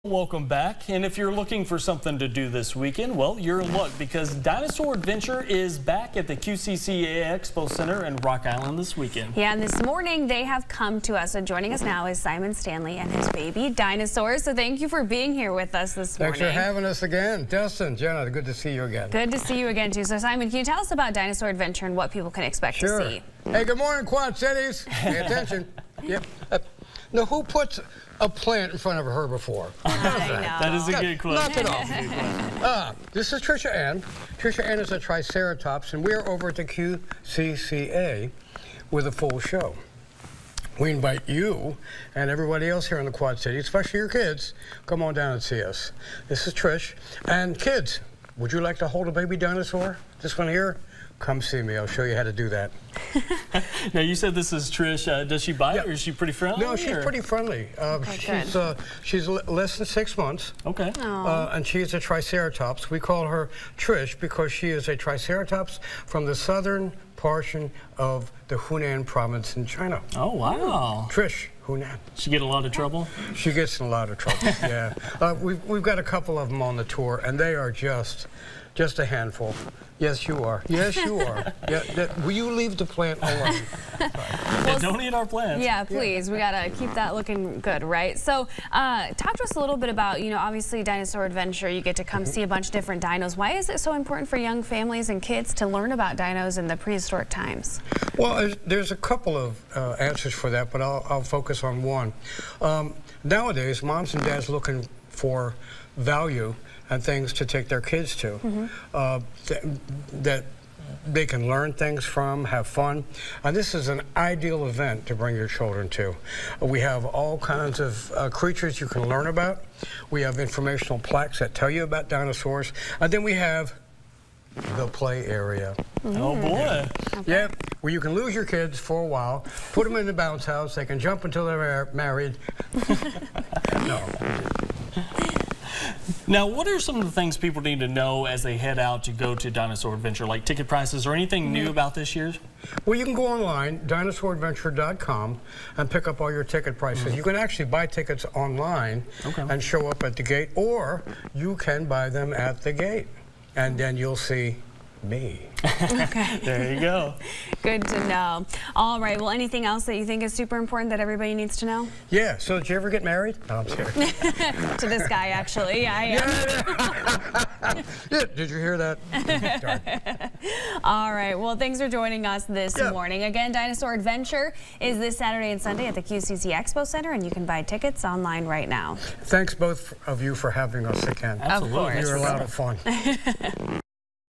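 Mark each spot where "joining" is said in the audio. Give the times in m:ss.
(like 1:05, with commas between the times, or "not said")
0:11, 2:51.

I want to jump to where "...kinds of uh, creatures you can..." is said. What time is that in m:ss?
1:57.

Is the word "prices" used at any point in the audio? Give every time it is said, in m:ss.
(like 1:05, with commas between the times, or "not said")
2:20, 2:26.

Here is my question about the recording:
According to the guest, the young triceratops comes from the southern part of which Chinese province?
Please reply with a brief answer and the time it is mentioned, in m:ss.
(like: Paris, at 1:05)
Hunan, at 1:08.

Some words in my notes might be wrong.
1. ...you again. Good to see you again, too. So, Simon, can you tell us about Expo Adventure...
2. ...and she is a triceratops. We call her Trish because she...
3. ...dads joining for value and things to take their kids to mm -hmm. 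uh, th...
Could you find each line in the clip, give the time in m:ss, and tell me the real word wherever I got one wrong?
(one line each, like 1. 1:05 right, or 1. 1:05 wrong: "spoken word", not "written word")
1. 0:18 wrong: "Dinosaur", not "Expo"
2. 1:01 right
3. 1:44 wrong: "looking", not "joining".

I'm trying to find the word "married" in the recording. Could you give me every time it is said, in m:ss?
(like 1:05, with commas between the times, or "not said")
2:11, 2:43.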